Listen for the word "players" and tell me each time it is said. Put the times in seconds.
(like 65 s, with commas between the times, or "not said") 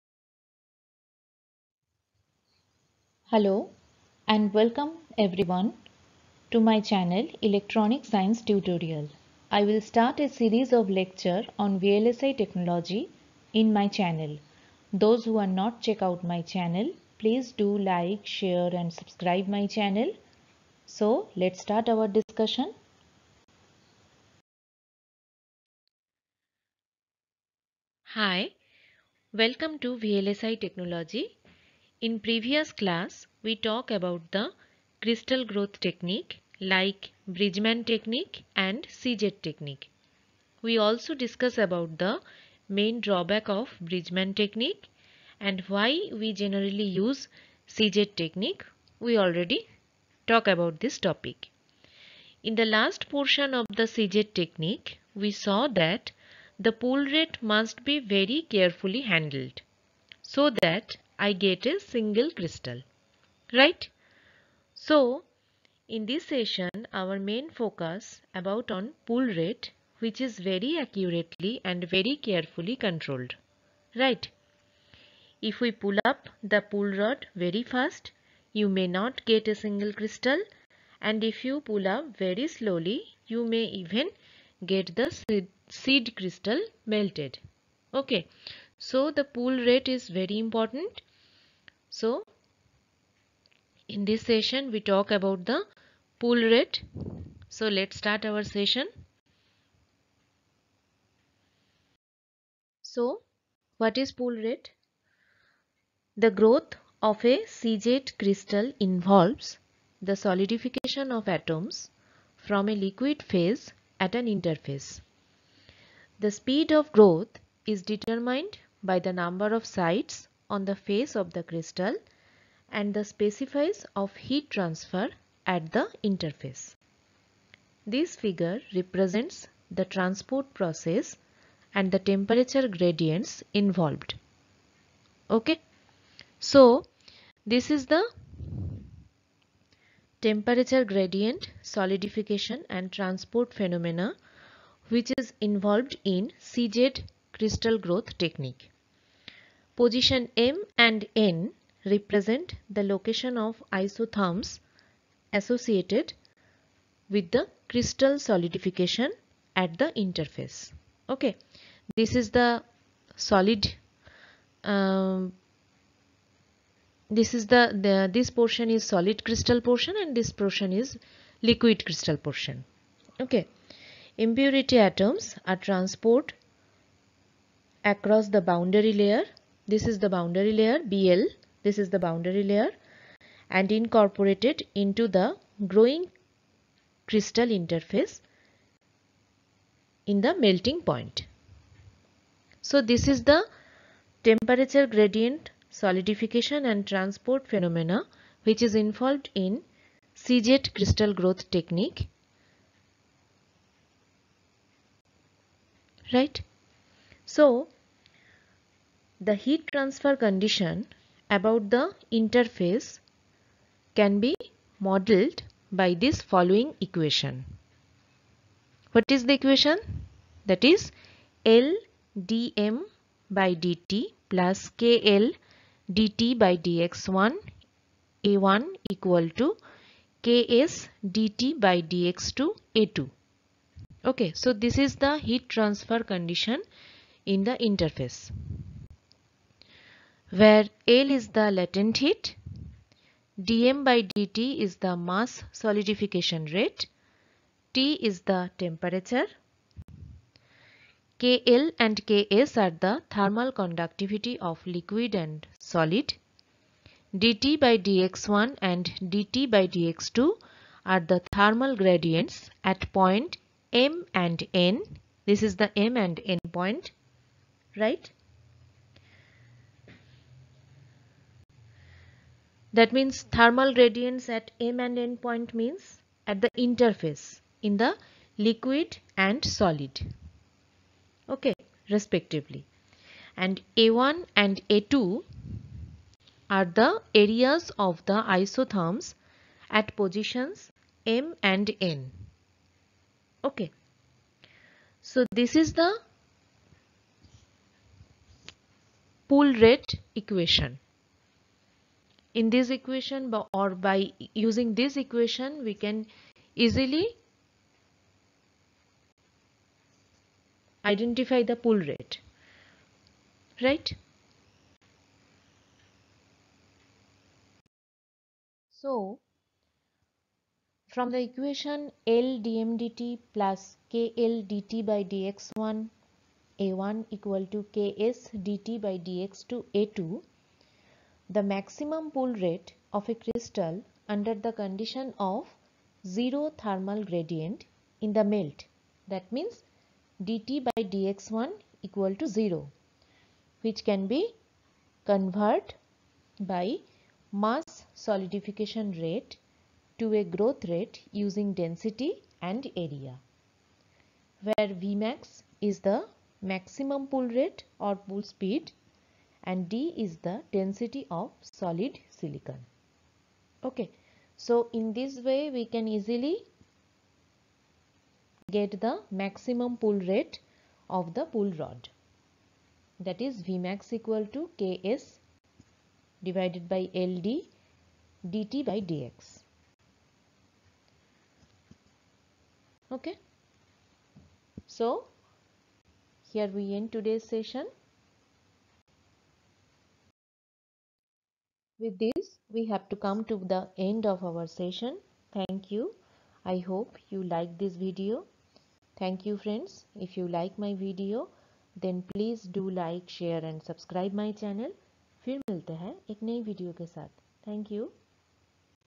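not said.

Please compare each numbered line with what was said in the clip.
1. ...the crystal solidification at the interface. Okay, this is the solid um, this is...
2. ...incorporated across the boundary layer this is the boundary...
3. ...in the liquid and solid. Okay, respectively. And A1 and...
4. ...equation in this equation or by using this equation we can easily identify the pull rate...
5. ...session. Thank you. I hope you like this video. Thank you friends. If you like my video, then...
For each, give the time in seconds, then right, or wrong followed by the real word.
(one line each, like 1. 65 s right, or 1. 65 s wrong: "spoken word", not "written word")
1. 157 s right
2. 175 s wrong: "transported", not "incorporated"
3. 277 s right
4. 300 s right
5. 394 s right.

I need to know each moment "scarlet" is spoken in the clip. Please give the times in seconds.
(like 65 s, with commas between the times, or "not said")
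not said.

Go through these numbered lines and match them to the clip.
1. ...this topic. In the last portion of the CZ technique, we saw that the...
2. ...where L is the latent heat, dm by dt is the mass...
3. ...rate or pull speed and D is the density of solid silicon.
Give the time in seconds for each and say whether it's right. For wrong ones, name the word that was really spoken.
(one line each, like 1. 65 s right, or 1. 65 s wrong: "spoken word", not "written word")
1. 50 s right
2. 240 s right
3. 357 s right.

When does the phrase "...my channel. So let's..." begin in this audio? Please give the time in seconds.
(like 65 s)
19 s.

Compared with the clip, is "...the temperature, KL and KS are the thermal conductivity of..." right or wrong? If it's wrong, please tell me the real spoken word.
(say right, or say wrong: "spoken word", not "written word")
right.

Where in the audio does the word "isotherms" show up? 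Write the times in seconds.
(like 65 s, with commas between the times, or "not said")
153 s, 288 s.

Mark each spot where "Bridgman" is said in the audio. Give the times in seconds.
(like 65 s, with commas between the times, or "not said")
37 s, 43 s.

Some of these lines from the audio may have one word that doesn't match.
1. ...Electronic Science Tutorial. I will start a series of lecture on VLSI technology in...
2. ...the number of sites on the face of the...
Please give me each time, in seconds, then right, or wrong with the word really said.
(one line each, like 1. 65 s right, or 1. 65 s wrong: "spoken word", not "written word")
1. 7 s right
2. 118 s right.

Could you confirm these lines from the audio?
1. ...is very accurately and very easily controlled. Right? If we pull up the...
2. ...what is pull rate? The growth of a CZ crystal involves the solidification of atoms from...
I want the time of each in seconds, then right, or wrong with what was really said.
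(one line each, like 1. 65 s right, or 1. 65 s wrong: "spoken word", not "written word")
1. 70 s wrong: "carefully", not "easily"
2. 103 s right.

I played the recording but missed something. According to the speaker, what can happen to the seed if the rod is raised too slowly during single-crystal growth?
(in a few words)
seed crystal melted.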